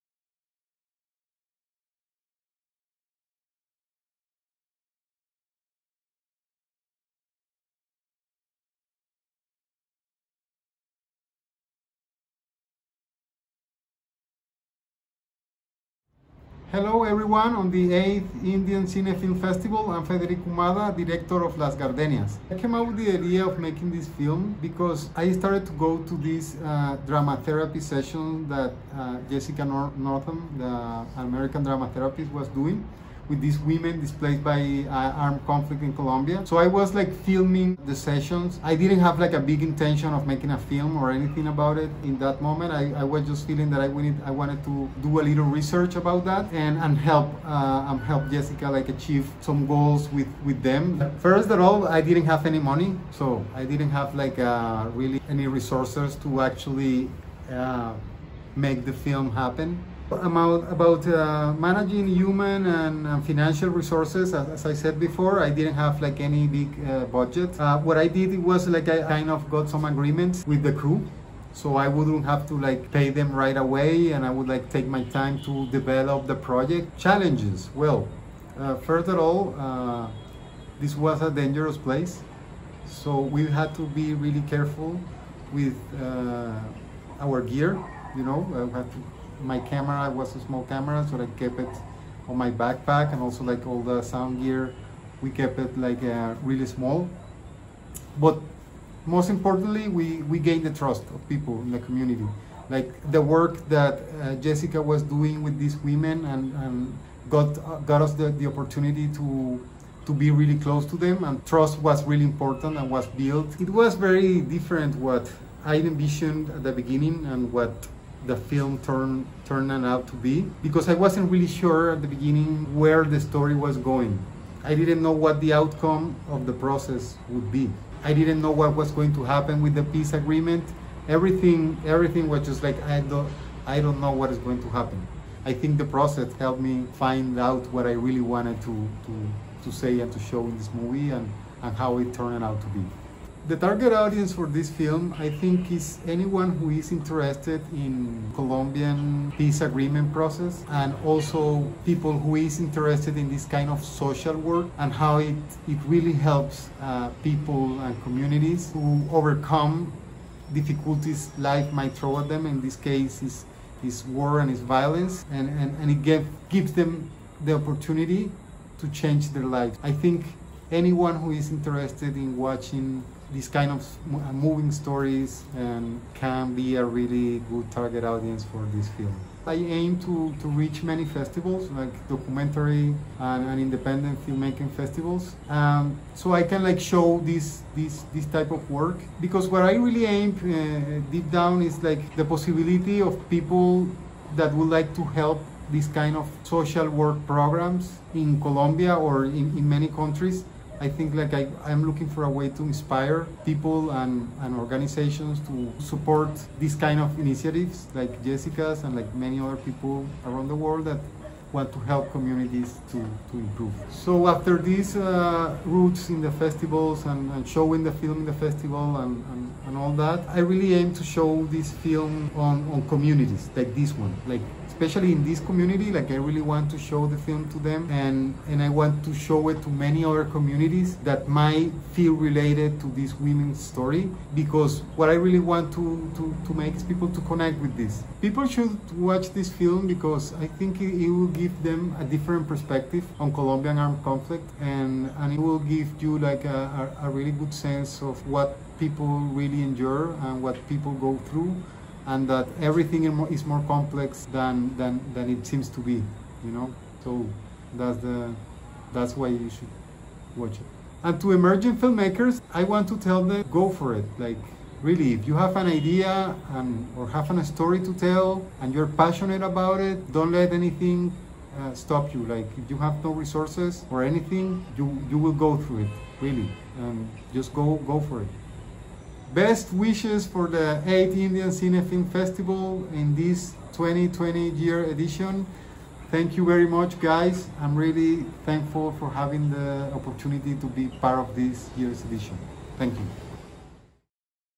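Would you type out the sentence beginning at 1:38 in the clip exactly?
But most importantly, we, we gained the trust of people in the community.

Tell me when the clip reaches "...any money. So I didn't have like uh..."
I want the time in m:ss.
0:52.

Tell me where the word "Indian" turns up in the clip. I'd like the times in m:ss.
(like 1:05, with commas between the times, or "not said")
0:18, 4:41.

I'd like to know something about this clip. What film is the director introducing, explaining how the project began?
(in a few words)
Las Gardenias.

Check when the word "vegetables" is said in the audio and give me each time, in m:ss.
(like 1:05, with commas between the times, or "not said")
not said.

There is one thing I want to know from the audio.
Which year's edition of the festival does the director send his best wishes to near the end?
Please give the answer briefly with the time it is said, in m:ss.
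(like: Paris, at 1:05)
2020, at 4:43.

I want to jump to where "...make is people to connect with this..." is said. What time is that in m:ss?
3:56.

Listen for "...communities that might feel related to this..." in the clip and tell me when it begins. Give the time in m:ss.
3:50.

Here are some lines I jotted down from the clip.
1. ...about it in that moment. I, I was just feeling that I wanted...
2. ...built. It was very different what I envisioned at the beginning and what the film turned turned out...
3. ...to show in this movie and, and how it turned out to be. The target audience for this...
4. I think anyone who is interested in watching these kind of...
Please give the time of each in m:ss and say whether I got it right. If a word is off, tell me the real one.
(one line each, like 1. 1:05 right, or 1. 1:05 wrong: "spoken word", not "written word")
1. 0:41 right
2. 1:53 right
3. 2:20 right
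4. 2:49 right.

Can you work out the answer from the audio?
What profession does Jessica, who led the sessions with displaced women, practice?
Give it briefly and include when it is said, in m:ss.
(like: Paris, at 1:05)
Drama therapist, at 0:31.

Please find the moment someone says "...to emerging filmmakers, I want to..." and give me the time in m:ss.
4:21.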